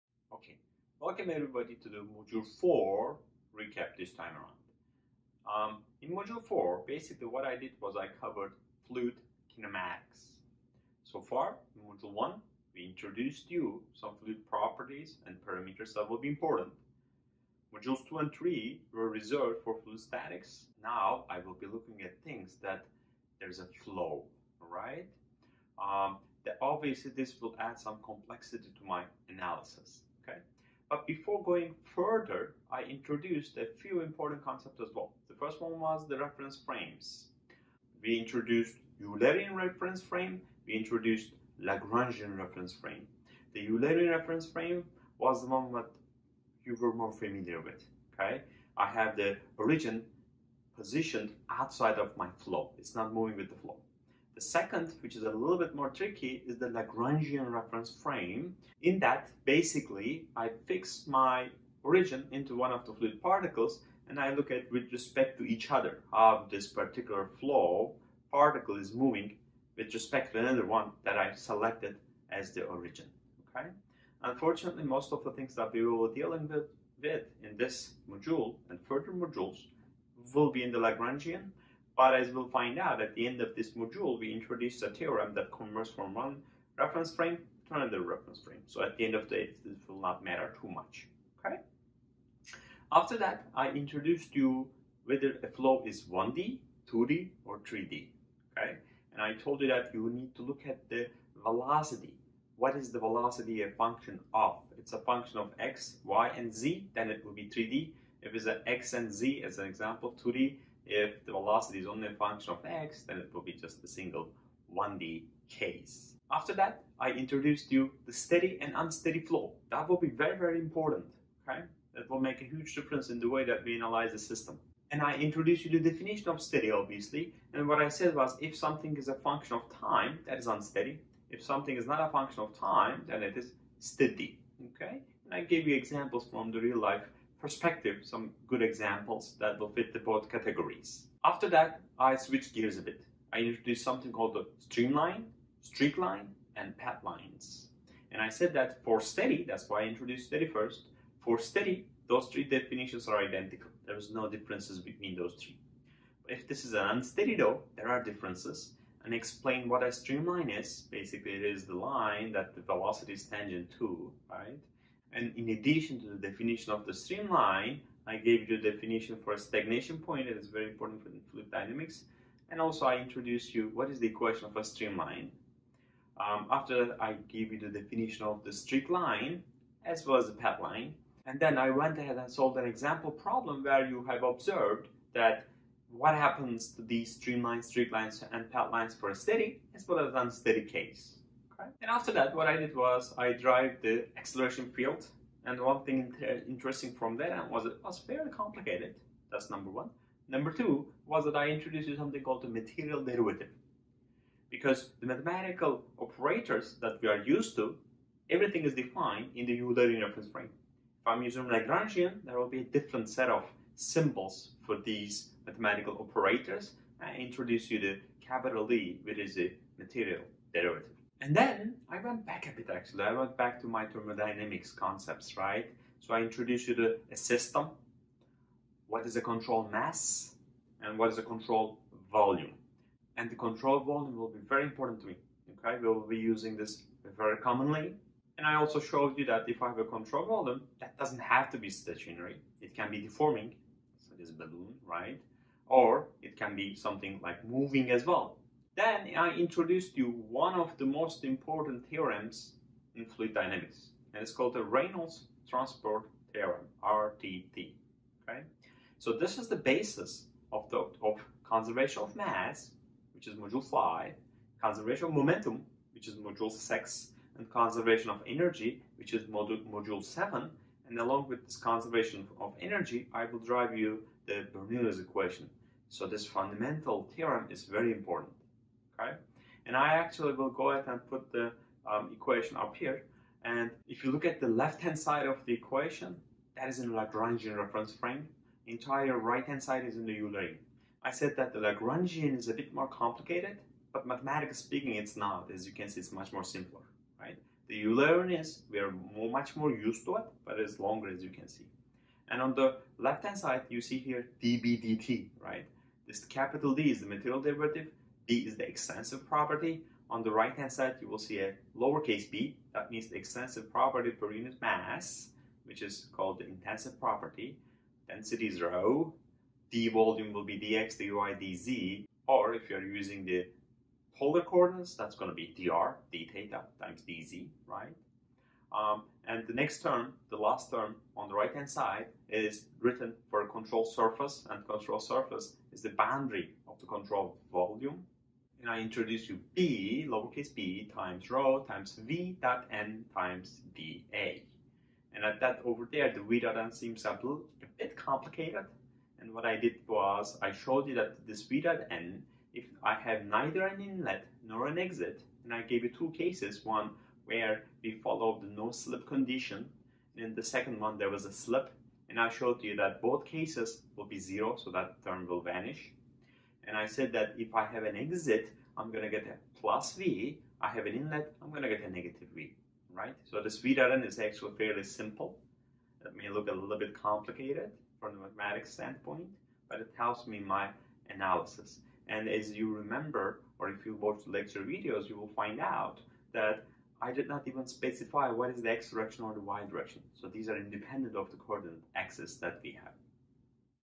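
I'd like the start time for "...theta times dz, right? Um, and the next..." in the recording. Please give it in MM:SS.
05:26.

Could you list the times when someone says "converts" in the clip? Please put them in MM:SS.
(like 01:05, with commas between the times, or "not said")
01:25.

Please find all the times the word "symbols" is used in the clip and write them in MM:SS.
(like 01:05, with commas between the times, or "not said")
03:33.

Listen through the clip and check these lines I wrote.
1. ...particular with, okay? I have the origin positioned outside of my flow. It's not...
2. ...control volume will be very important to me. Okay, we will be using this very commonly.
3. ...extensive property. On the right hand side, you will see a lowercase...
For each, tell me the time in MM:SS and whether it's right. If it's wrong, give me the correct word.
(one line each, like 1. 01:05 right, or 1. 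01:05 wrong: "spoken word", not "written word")
1. 00:47 wrong: "familiar", not "particular"
2. 03:53 right
3. 05:08 right.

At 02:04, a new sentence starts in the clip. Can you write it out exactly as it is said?
And I introduced you the definition of steady, obviously.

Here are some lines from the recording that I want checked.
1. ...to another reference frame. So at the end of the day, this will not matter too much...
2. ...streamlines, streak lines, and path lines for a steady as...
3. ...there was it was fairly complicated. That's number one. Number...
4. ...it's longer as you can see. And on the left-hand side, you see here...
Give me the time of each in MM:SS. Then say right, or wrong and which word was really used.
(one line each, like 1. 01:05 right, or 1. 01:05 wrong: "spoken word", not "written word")
1. 01:27 right
2. 03:07 right
3. 03:17 right
4. 05:00 right.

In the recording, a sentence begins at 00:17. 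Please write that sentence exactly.
Modules 2 and 3 were reserved for fluid statics.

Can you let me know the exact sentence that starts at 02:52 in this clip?
And also I introduced you what is the equation of a streamline.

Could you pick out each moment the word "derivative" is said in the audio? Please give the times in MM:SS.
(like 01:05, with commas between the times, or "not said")
03:23, 03:40, 05:07.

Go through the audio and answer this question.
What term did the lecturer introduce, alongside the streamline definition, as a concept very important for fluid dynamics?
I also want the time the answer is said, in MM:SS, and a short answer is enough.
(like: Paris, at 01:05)
stagnation point, at 02:49.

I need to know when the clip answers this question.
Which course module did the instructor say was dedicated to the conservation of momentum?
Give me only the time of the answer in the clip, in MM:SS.
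04:26.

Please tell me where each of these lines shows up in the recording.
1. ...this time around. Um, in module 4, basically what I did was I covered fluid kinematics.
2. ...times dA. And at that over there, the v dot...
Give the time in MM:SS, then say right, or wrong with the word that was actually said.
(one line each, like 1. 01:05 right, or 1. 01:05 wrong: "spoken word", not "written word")
1. 00:03 right
2. 05:43 right.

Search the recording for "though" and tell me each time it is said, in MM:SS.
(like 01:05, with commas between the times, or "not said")
02:37.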